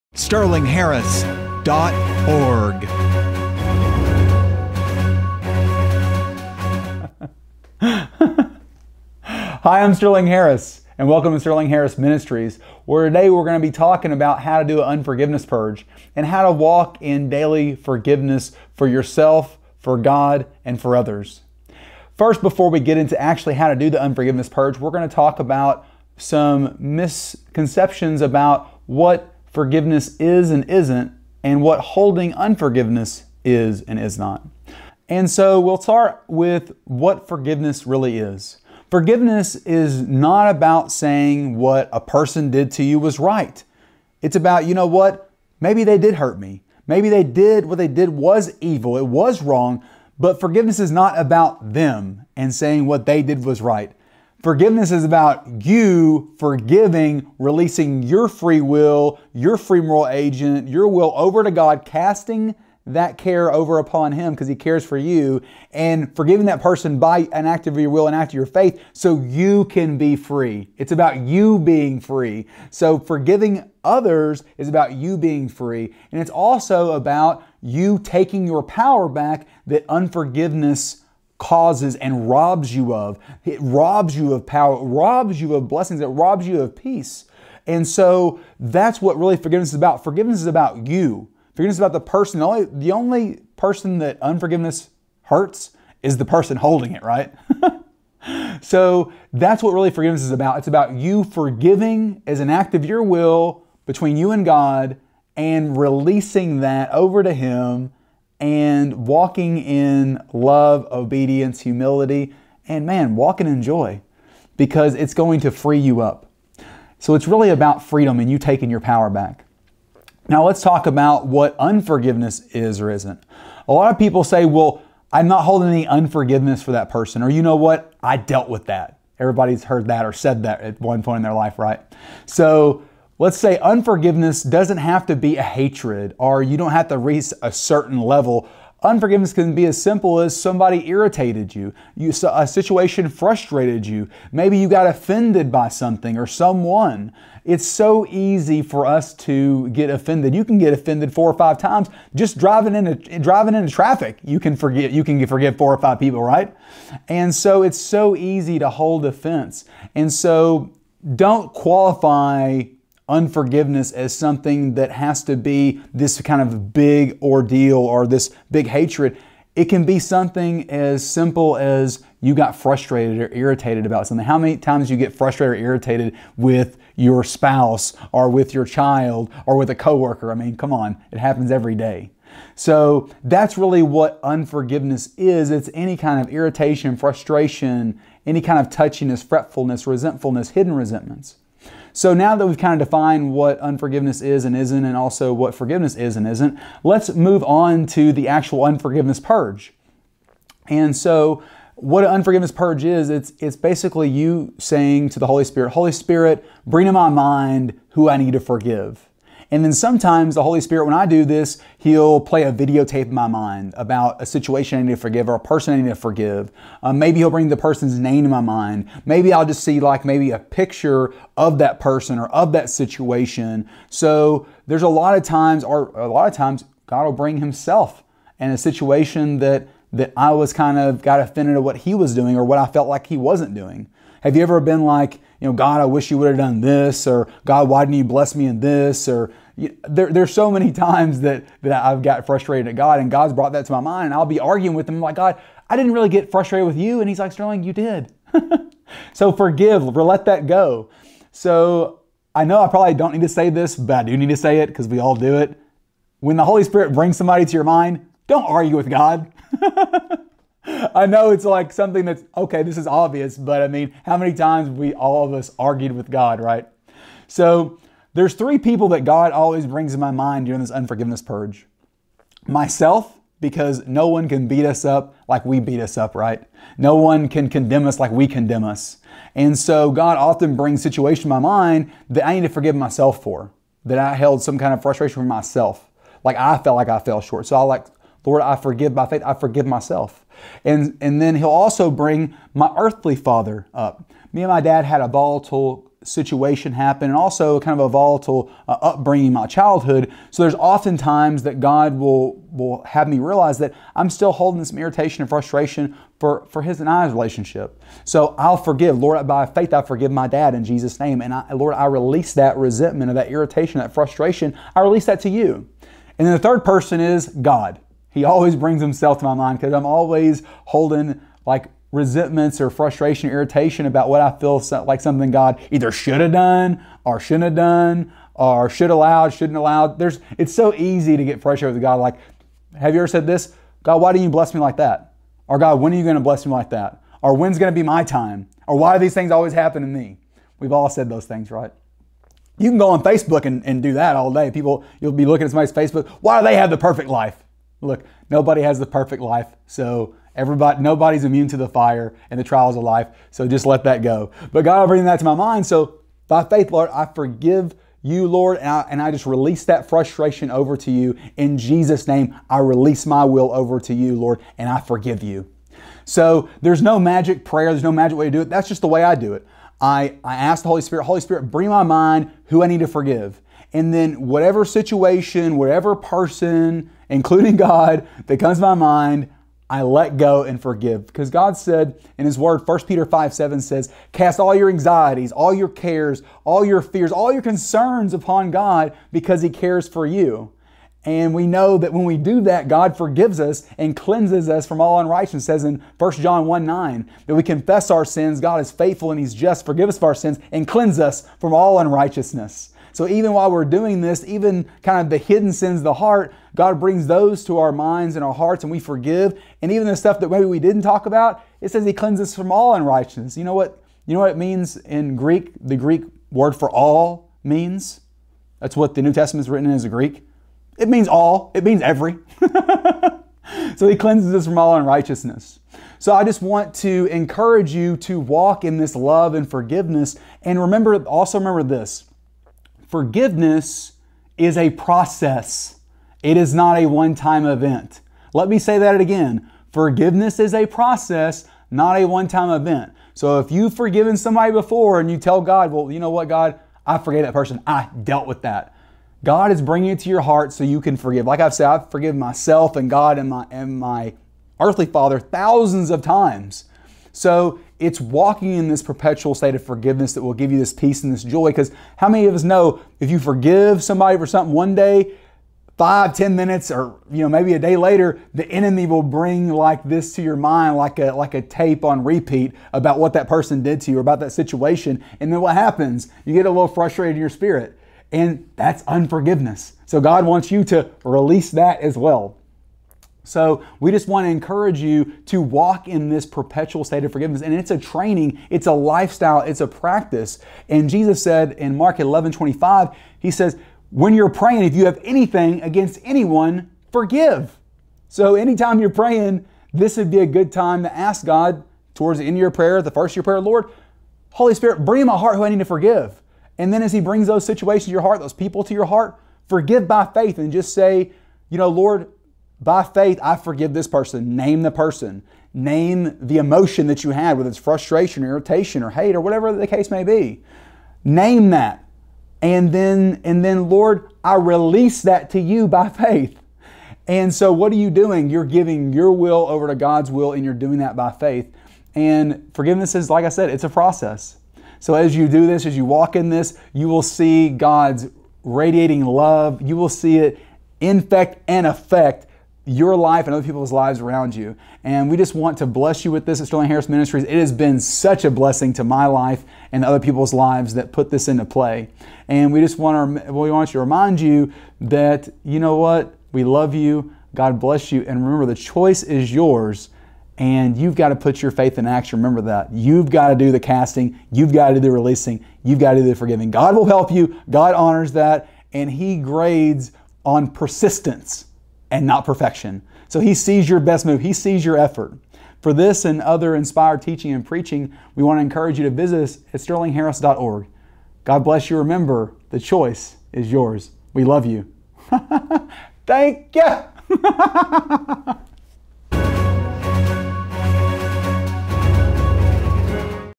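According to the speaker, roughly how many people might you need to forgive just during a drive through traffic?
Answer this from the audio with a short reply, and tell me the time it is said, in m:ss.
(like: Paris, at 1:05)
4 or 5, at 2:35.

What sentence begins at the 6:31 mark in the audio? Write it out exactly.
And we know that when we do that, God forgives us and cleanses us from all unrighteousness.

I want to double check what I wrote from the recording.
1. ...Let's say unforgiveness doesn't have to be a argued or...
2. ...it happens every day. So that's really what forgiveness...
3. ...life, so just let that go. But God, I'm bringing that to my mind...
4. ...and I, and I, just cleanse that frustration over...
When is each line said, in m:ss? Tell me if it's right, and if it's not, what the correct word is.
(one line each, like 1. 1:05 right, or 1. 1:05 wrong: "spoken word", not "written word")
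1. 2:13 wrong: "hatred", not "argued"
2. 3:01 wrong: "unforgiveness", not "forgiveness"
3. 5:52 right
4. 5:58 wrong: "release", not "cleanse".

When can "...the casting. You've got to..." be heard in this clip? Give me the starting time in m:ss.
9:23.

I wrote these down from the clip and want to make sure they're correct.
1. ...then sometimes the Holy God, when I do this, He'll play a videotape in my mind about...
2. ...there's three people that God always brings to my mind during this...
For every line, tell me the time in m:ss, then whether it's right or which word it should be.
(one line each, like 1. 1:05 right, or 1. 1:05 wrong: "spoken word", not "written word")
1. 3:29 wrong: "Spirit", not "God"
2. 4:28 right.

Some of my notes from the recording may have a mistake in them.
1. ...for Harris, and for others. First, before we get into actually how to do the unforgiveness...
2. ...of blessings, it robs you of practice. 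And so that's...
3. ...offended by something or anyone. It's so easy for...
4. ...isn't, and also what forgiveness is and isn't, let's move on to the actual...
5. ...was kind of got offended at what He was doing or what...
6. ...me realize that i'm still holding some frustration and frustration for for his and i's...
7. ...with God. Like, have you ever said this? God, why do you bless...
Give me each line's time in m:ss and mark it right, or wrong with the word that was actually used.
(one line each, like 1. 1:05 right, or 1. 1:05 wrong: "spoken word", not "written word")
1. 0:19 wrong: "God", not "Harris"
2. 1:25 wrong: "peace", not "practice"
3. 2:24 wrong: "someone", not "anyone"
4. 3:14 right
5. 3:50 right
6. 5:03 wrong: "irritation", not "frustration"
7. 5:31 right.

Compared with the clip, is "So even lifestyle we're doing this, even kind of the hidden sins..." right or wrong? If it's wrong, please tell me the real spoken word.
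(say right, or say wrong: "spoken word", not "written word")
wrong: "while", not "lifestyle".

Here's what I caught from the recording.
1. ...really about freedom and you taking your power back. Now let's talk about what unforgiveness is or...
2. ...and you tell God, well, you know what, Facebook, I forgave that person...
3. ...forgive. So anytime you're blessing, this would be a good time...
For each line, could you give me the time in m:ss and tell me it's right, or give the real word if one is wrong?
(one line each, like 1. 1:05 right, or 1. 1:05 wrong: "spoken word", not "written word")
1. 1:57 right
2. 7:24 wrong: "God", not "Facebook"
3. 8:16 wrong: "praying", not "blessing".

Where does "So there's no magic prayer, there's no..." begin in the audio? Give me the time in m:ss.
6:06.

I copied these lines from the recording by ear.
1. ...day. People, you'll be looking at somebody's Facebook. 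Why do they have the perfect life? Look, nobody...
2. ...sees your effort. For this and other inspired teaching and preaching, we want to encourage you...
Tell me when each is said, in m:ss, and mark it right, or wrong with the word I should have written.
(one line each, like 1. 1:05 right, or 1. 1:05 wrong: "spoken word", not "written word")
1. 5:44 right
2. 9:34 right.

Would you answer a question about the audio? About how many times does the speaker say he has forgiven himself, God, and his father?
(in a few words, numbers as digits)
Thousands.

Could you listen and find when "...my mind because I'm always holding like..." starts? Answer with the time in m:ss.
5:19.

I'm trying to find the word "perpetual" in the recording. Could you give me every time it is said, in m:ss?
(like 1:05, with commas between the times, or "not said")
7:38, 8:06.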